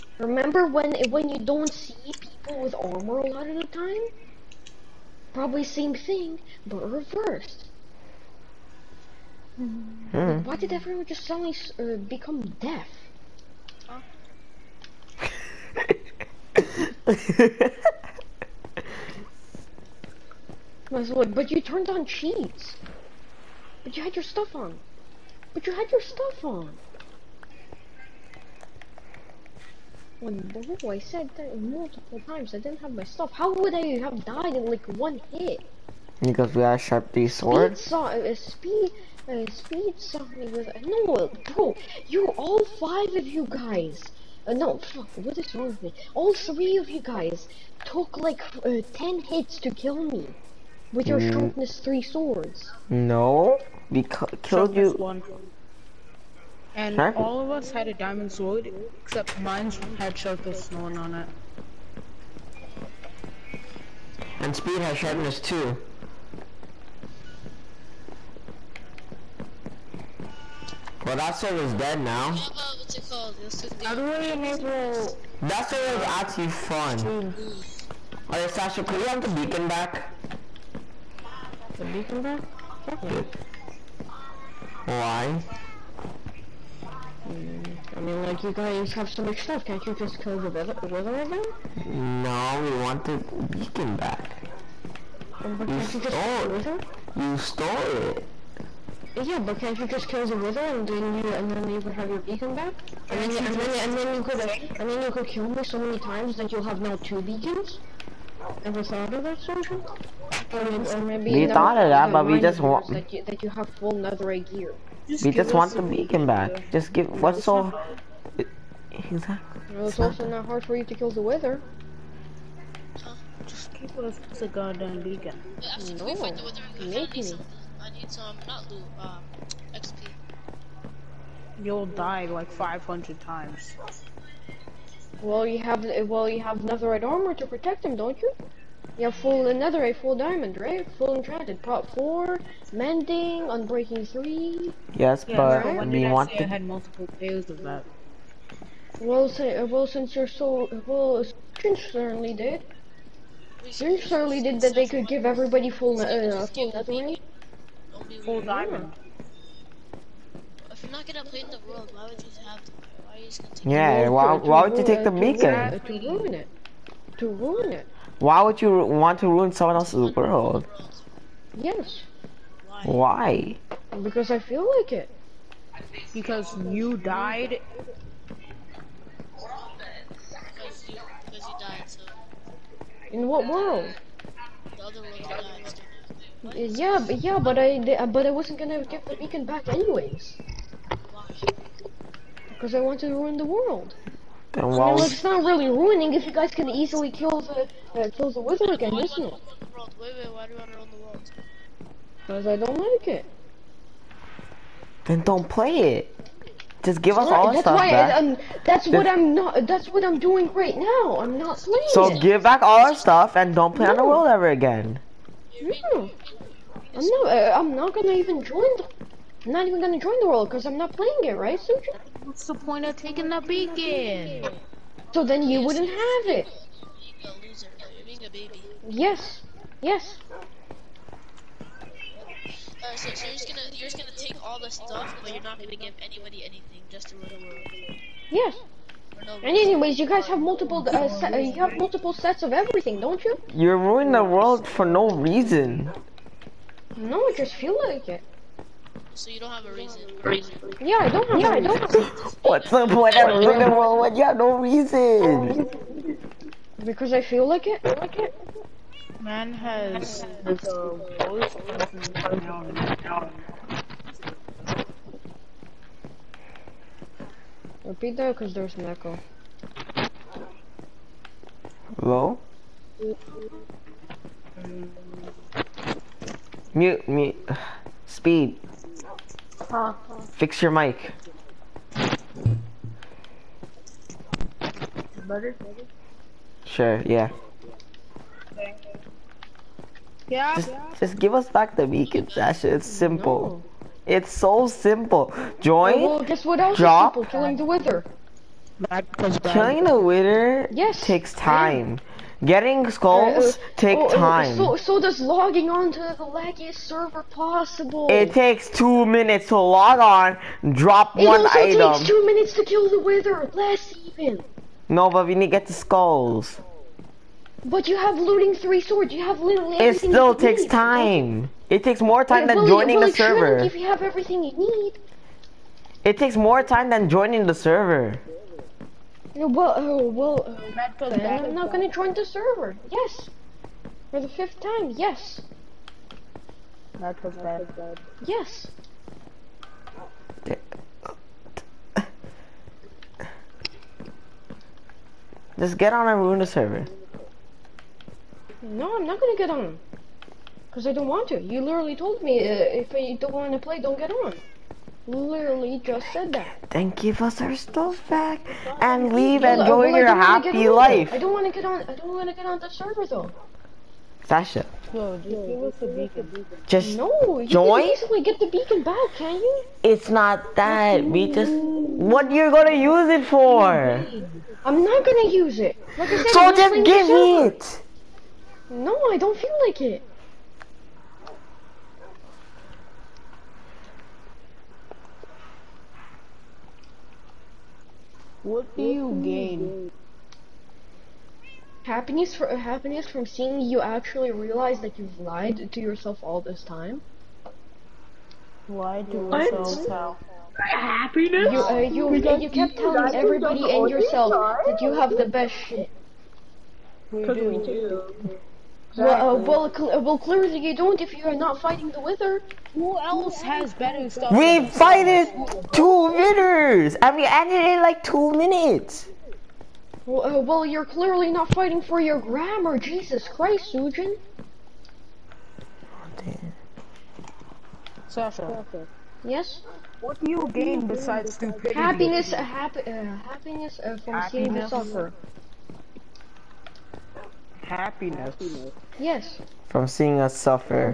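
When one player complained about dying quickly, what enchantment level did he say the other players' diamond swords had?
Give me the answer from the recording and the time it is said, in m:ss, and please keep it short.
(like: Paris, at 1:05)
Sharpness 3, at 0:51.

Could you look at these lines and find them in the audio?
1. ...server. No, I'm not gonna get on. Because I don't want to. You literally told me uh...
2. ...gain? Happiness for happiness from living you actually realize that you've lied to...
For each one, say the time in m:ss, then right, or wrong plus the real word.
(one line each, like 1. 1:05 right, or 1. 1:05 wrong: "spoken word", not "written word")
1. 5:46 right
2. 6:29 wrong: "seeing", not "living".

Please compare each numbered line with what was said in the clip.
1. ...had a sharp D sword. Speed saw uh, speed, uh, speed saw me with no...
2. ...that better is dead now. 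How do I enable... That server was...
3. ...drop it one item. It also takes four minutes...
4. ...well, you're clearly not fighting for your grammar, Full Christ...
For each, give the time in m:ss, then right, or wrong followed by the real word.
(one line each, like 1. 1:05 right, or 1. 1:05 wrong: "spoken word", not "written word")
1. 0:36 right
2. 1:11 wrong: "server", not "better"
3. 5:10 wrong: "two", not "four"
4. 7:00 wrong: "Jesus", not "Full".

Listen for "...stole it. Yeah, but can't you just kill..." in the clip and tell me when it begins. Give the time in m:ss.
1:37.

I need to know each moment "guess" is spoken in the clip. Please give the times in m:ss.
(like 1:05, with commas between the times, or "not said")
4:56.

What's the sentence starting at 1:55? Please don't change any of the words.
Just we just want the beacon back.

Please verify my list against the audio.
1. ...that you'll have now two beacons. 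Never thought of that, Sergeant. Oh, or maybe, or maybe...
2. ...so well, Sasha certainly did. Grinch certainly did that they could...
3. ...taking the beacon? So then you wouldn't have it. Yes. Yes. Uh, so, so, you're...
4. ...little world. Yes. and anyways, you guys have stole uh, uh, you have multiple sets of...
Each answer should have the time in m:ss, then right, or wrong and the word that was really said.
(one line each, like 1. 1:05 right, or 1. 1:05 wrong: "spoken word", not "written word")
1. 1:46 right
2. 2:30 wrong: "Grinch", not "Sasha"
3. 3:42 right
4. 3:57 wrong: "multiple", not "stole".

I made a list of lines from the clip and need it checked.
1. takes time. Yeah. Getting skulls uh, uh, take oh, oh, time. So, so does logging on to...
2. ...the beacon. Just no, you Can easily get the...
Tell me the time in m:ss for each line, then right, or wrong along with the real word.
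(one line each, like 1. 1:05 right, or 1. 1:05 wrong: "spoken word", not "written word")
1. 5:01 right
2. 6:05 right.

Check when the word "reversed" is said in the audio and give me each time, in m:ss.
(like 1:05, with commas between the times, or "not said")
0:06.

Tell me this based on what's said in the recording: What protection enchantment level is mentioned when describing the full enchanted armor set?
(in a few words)
Prot 4.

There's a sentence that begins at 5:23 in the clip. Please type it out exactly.
If you have everything you need.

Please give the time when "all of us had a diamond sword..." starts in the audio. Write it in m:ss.
0:57.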